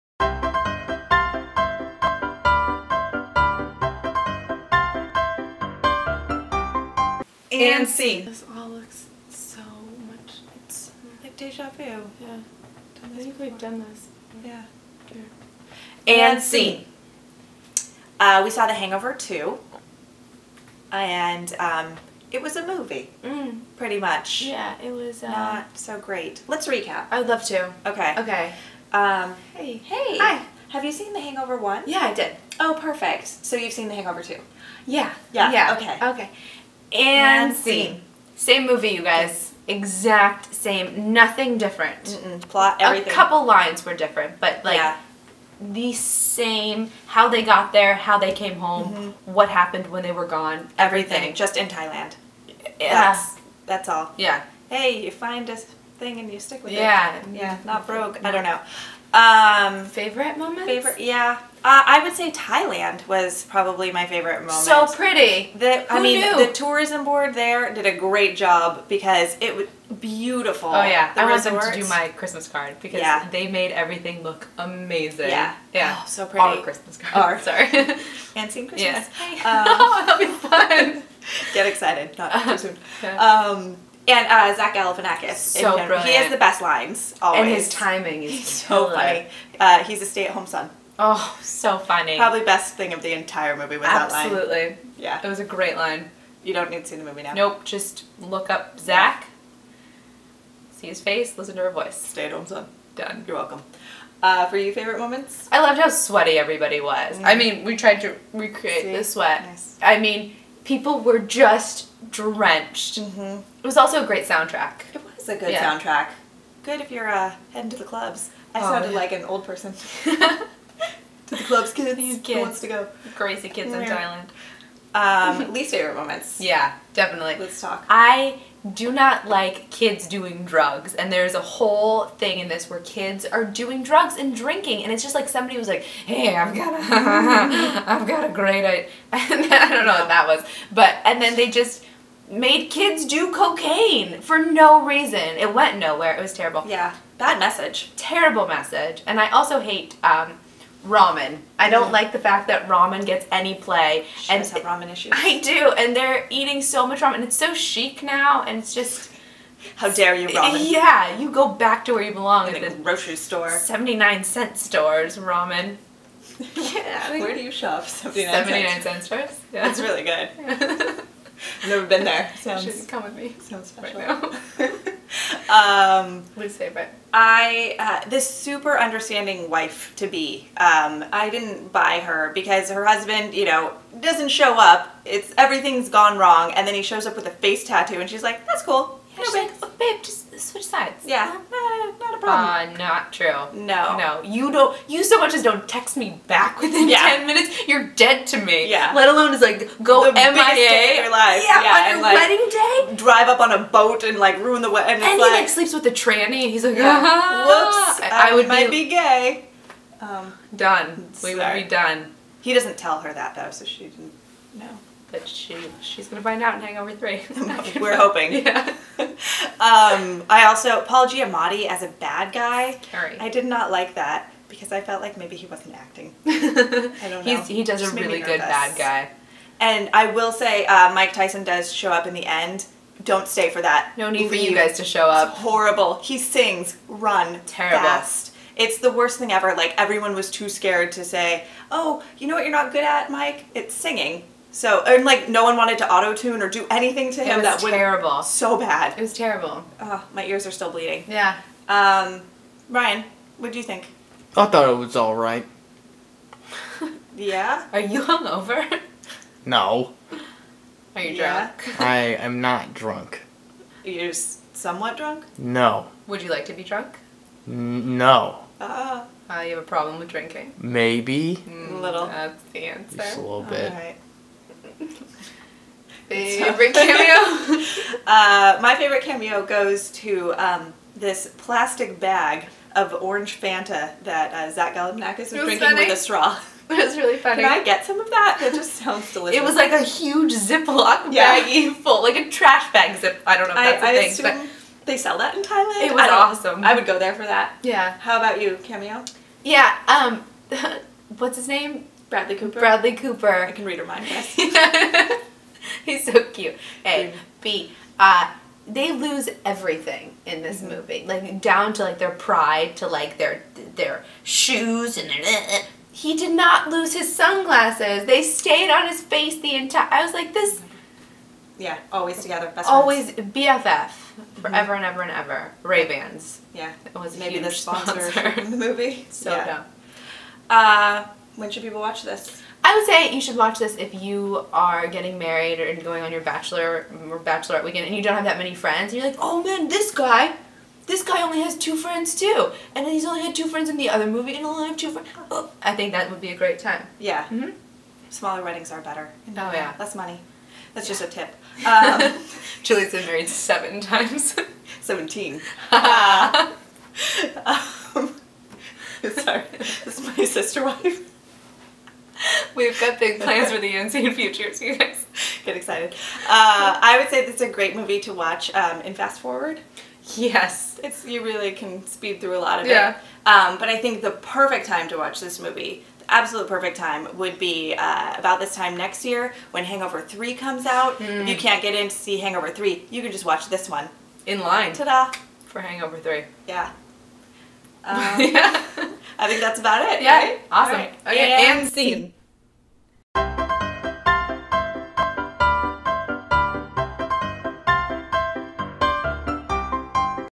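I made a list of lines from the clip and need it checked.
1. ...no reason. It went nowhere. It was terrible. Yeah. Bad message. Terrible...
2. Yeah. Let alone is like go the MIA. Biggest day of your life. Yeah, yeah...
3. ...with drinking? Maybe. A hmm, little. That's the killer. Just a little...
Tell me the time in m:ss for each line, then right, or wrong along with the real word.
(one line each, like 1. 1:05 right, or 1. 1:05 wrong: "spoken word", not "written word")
1. 2:24 right
2. 3:18 right
3. 4:29 wrong: "answer", not "killer".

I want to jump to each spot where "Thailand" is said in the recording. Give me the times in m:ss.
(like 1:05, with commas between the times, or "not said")
0:51, 1:02, 2:04, 4:55.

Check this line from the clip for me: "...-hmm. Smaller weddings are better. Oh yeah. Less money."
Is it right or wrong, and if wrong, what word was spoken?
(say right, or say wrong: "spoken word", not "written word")
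right.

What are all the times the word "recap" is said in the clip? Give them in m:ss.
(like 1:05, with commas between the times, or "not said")
0:26.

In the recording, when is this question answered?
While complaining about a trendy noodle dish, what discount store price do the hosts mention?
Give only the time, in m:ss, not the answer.
2:43.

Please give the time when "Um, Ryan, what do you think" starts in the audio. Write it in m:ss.
4:11.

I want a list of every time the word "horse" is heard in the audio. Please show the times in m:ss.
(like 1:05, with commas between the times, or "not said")
not said.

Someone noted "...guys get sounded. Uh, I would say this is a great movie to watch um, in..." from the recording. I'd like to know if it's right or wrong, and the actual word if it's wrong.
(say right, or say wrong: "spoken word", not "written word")
wrong: "excited", not "sounded".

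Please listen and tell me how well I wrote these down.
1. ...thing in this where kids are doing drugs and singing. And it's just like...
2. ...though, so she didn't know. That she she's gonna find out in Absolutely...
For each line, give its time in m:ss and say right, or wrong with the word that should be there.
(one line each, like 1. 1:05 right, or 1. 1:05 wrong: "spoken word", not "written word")
1. 2:12 wrong: "drinking", not "singing"
2. 3:33 wrong: "Hangover", not "Absolutely".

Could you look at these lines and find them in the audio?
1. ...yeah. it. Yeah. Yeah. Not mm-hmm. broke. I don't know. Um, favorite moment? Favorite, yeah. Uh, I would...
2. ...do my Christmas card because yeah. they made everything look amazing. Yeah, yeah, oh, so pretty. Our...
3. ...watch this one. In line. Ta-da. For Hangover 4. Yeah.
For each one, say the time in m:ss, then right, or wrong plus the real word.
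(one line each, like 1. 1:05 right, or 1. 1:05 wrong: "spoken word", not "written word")
1. 0:56 right
2. 1:11 right
3. 6:23 wrong: "3", not "4".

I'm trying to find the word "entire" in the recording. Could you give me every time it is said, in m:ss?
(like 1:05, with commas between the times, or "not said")
1:33, 5:19.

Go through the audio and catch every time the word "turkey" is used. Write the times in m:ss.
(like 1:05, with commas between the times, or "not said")
not said.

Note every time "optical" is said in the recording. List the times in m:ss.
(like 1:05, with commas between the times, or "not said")
not said.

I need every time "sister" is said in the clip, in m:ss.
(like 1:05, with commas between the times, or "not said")
6:00.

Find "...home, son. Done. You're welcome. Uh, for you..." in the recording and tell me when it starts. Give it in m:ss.
1:42.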